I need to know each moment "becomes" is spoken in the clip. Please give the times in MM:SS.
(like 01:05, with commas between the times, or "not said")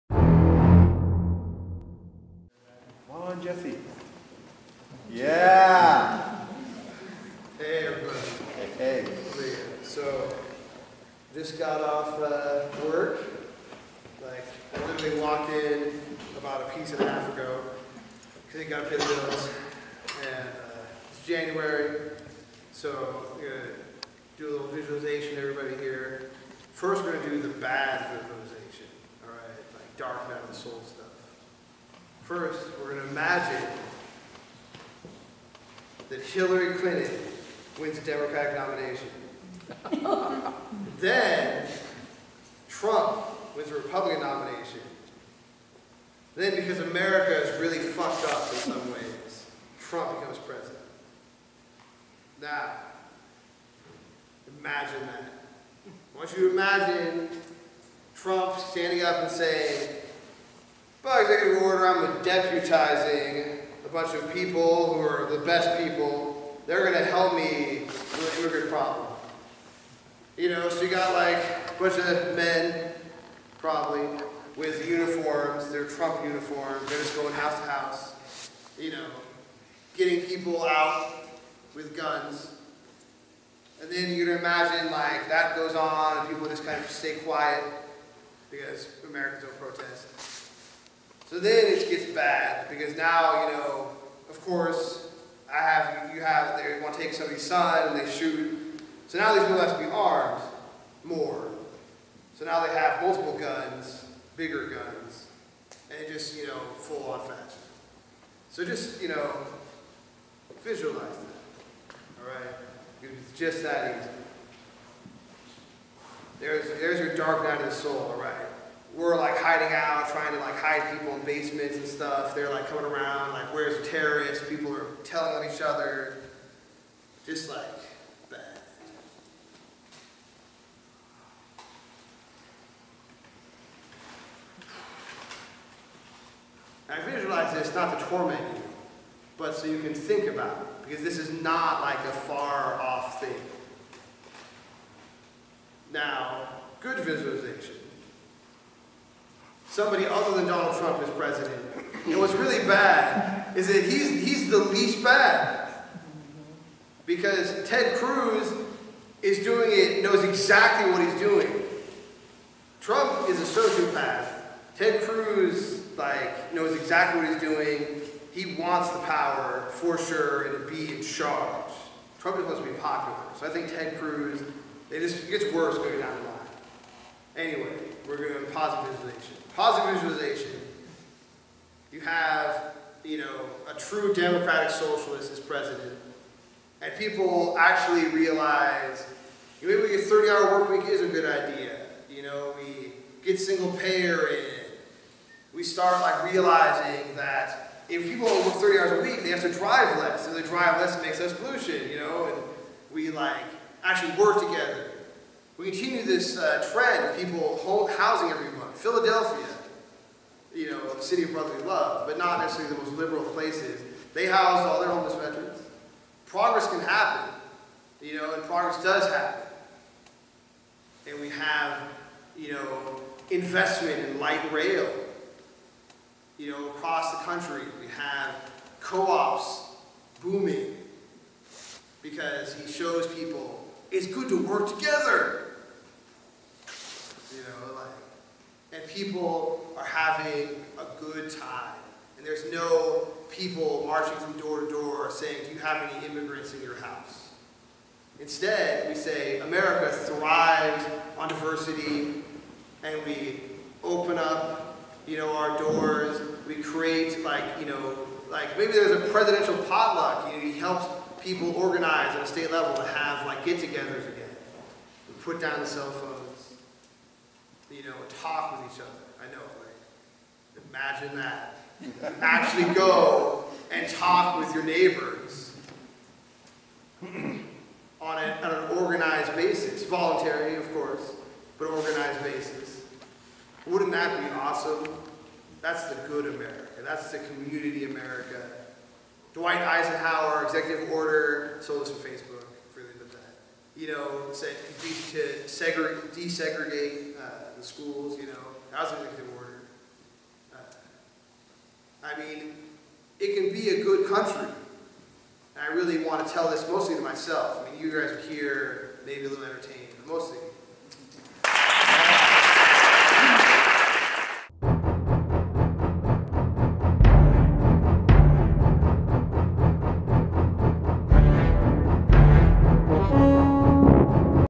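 00:50.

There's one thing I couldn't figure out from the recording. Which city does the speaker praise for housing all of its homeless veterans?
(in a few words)
Philadelphia.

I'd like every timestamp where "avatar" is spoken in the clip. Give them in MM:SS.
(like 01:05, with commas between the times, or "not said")
not said.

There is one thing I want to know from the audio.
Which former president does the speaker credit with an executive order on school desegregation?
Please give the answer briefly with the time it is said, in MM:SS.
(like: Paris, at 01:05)
Dwight Eisenhower, at 04:49.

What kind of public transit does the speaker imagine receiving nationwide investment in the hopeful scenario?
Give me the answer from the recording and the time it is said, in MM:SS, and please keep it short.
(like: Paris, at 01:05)
light rail, at 03:44.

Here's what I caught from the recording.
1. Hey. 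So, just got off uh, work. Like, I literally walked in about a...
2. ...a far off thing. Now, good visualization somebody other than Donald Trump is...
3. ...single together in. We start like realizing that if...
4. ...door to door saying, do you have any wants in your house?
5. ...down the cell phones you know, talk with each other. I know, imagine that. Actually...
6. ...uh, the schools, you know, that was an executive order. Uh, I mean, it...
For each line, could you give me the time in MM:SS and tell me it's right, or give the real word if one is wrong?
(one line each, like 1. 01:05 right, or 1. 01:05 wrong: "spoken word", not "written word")
1. 00:08 right
2. 02:21 right
3. 03:13 wrong: "payer", not "together"
4. 04:04 wrong: "immigrants", not "wants"
5. 04:25 right
6. 04:57 right.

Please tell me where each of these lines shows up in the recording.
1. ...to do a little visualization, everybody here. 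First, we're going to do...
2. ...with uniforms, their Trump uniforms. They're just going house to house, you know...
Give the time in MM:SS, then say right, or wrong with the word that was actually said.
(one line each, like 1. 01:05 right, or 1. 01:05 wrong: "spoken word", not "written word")
1. 00:23 right
2. 01:14 right.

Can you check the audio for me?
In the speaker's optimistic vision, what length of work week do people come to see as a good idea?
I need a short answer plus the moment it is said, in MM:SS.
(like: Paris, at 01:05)
30 hour, at 03:09.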